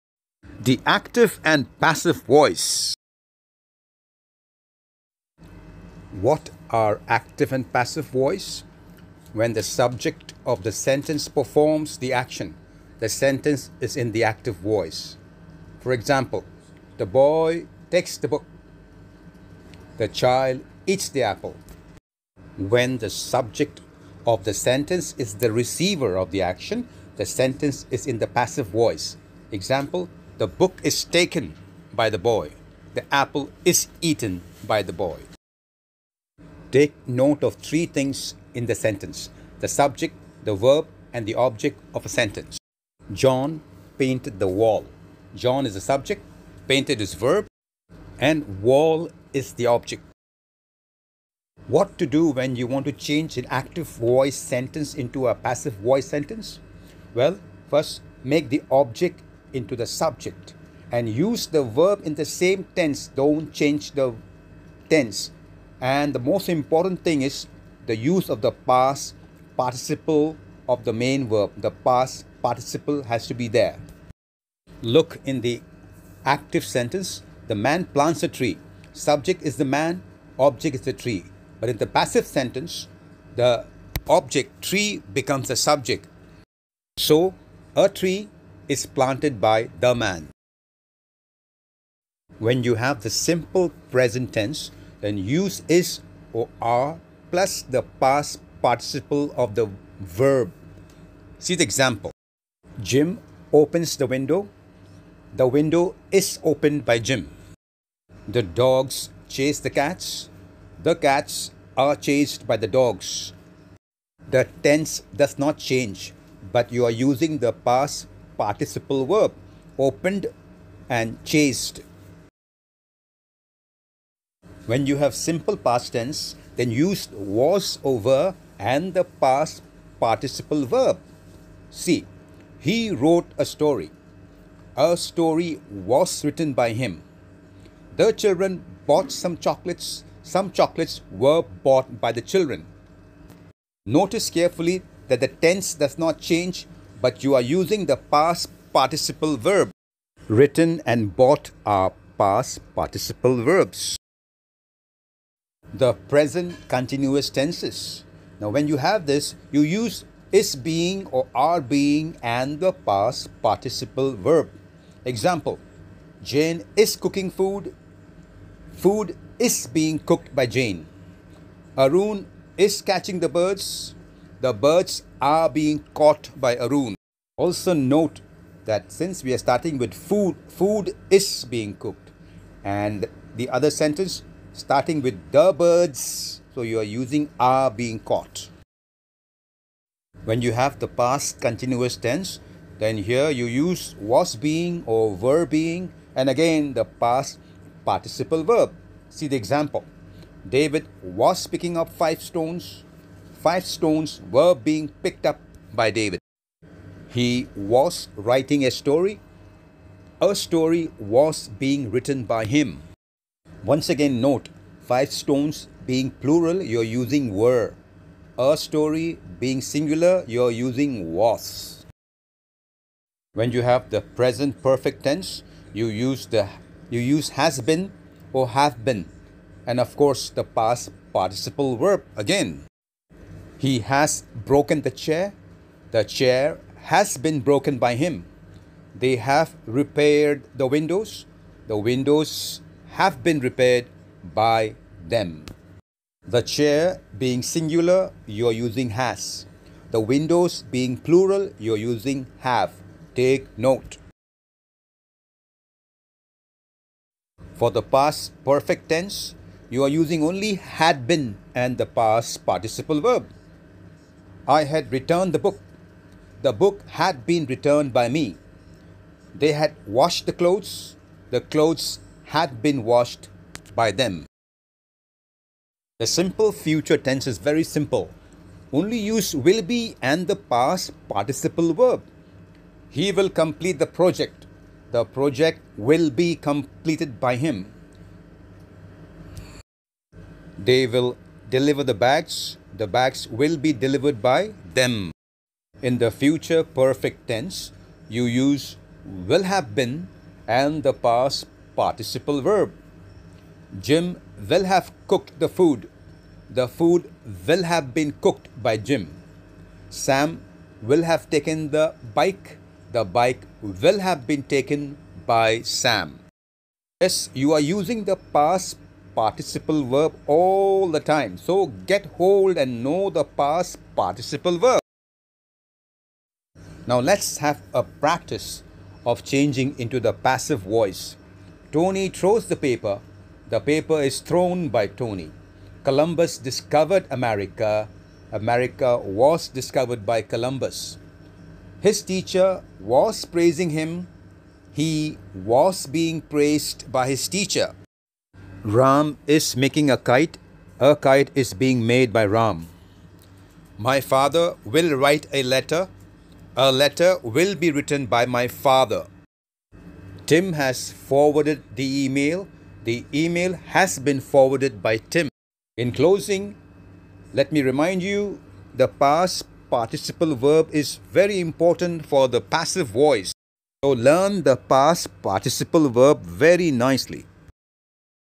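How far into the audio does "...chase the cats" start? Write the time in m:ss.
1:49.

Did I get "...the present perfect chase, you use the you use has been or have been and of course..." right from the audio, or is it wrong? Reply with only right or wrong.
wrong.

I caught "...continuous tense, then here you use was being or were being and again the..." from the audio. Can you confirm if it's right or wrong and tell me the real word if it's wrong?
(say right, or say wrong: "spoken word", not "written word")
right.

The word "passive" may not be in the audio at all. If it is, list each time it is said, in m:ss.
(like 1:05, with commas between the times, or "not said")
0:01, 0:07, 0:28, 0:55, 1:21, 5:30, 6:12.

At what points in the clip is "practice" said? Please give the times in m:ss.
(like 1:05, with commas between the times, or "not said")
5:27.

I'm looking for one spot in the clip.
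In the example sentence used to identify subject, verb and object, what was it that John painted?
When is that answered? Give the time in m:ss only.
0:44.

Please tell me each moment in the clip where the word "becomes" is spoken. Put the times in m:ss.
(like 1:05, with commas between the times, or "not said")
1:25.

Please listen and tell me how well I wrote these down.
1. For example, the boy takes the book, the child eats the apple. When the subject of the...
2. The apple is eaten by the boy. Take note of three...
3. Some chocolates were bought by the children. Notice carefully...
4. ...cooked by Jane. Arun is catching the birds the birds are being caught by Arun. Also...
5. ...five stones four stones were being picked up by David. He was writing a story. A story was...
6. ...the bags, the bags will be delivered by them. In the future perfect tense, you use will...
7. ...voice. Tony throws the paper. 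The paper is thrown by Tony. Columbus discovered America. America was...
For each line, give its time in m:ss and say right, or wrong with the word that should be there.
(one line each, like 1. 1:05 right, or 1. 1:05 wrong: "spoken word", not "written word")
1. 0:15 right
2. 0:32 right
3. 2:20 right
4. 2:49 right
5. 3:21 wrong: "five", not "four"
6. 4:51 right
7. 5:30 right.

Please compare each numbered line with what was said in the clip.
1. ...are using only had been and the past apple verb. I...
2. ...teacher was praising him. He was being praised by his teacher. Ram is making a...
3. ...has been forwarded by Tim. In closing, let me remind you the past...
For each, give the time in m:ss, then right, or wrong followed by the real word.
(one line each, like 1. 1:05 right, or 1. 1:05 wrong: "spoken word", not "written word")
1. 4:19 wrong: "participle", not "apple"
2. 5:42 right
3. 6:03 right.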